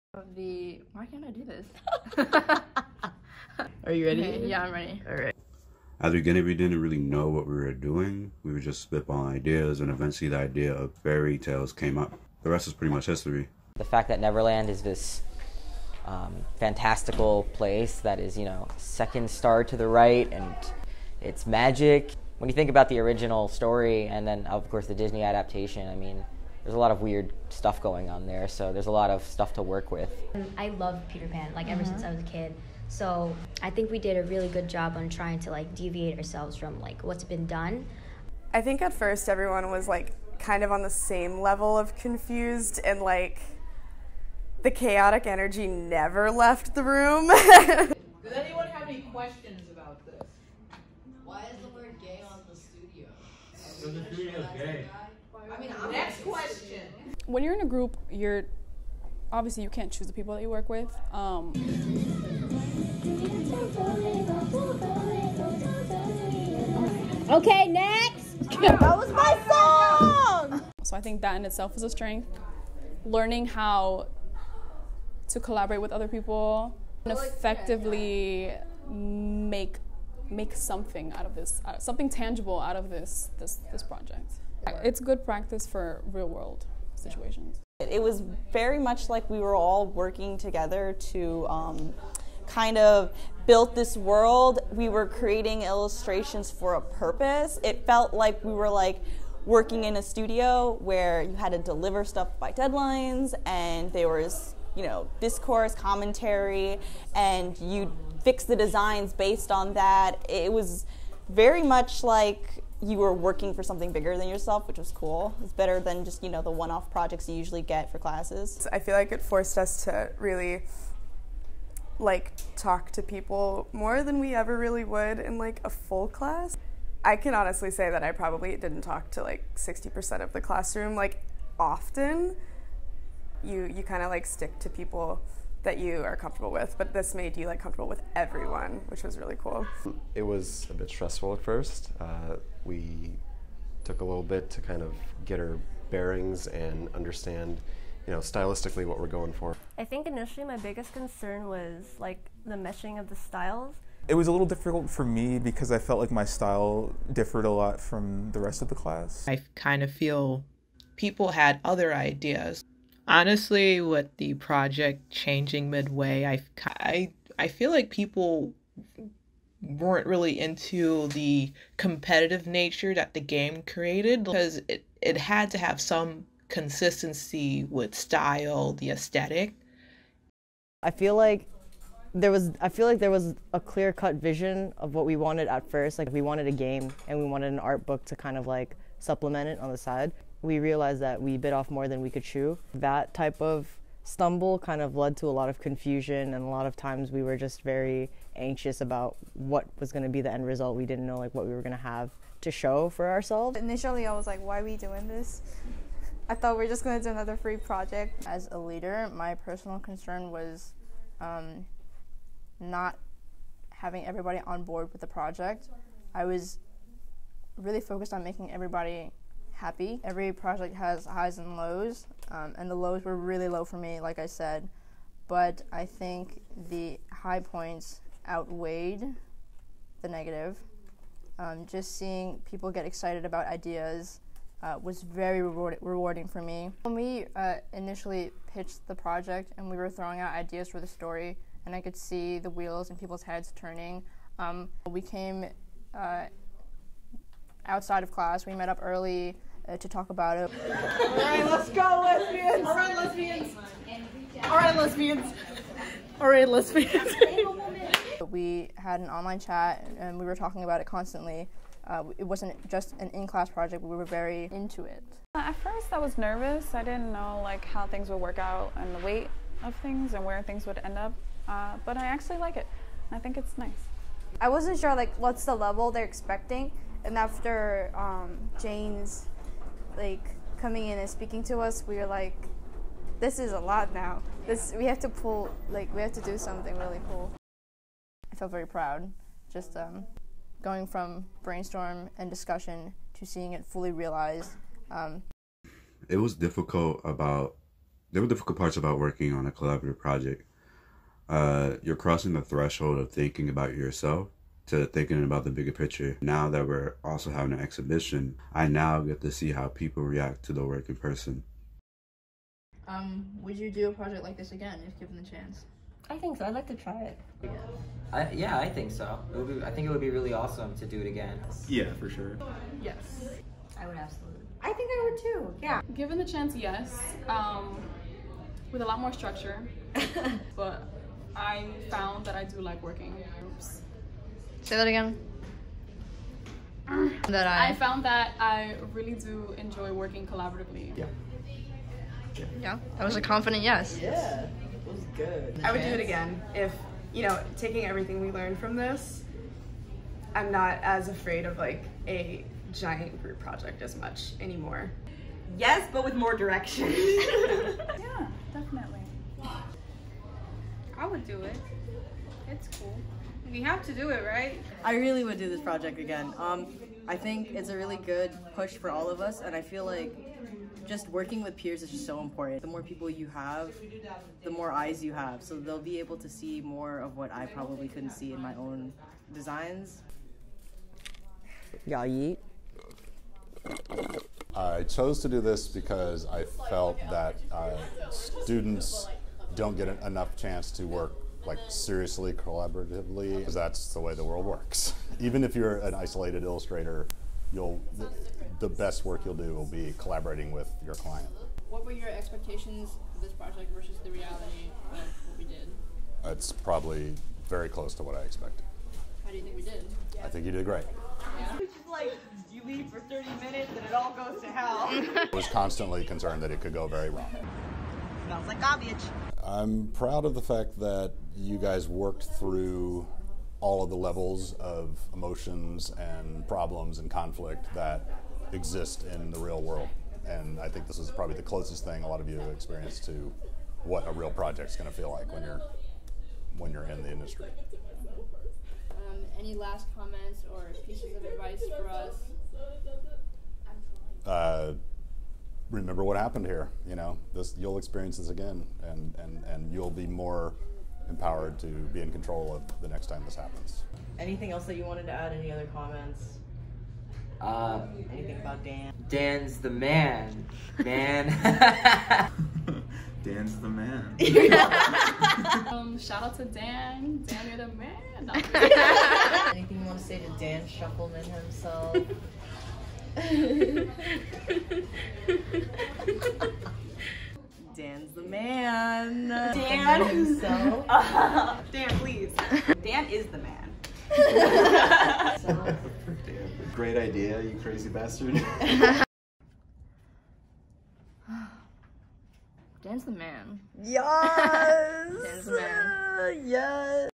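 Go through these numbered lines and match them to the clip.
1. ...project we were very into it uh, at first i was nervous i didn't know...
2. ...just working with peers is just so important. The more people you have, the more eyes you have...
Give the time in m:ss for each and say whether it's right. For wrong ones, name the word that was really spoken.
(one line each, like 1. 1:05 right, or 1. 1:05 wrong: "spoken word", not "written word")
1. 4:23 right
2. 6:10 right.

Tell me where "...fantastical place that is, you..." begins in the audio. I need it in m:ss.
0:16.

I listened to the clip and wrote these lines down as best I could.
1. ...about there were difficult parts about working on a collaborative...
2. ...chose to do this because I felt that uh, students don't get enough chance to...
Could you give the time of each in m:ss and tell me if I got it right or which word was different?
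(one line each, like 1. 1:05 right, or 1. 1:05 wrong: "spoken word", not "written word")
1. 4:57 right
2. 6:24 right.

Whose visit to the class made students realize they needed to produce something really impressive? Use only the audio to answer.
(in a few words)
Jane.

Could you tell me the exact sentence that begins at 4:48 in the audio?
I felt very proud, just um, going from brainstorm and discussion to seeing it fully realized.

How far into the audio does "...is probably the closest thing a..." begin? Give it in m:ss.
7:10.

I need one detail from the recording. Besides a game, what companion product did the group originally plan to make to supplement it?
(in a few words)
An art book.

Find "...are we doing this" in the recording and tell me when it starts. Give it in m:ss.
3:24.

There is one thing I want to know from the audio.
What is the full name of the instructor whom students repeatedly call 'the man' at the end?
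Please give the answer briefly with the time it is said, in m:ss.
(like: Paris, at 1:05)
Dan Shefelman, at 7:50.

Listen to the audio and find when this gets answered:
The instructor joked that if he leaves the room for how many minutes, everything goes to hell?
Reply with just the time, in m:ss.
6:52.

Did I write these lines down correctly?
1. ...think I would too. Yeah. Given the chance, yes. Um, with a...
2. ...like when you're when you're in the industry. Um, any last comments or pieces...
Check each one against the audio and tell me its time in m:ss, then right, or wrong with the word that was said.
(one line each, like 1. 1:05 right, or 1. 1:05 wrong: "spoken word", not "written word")
1. 5:24 right
2. 7:15 right.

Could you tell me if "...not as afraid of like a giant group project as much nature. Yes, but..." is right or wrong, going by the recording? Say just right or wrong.
wrong.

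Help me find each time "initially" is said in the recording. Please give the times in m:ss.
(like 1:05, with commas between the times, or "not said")
2:30, 3:23, 3:57.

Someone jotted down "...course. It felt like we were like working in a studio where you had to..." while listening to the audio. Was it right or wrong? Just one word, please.
wrong.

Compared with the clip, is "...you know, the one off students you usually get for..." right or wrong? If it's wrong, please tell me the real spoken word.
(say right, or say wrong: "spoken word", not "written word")
wrong: "projects", not "students".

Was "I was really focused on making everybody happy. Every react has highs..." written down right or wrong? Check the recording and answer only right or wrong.
wrong.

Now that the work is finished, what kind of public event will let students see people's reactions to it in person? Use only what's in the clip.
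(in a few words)
An exhibition.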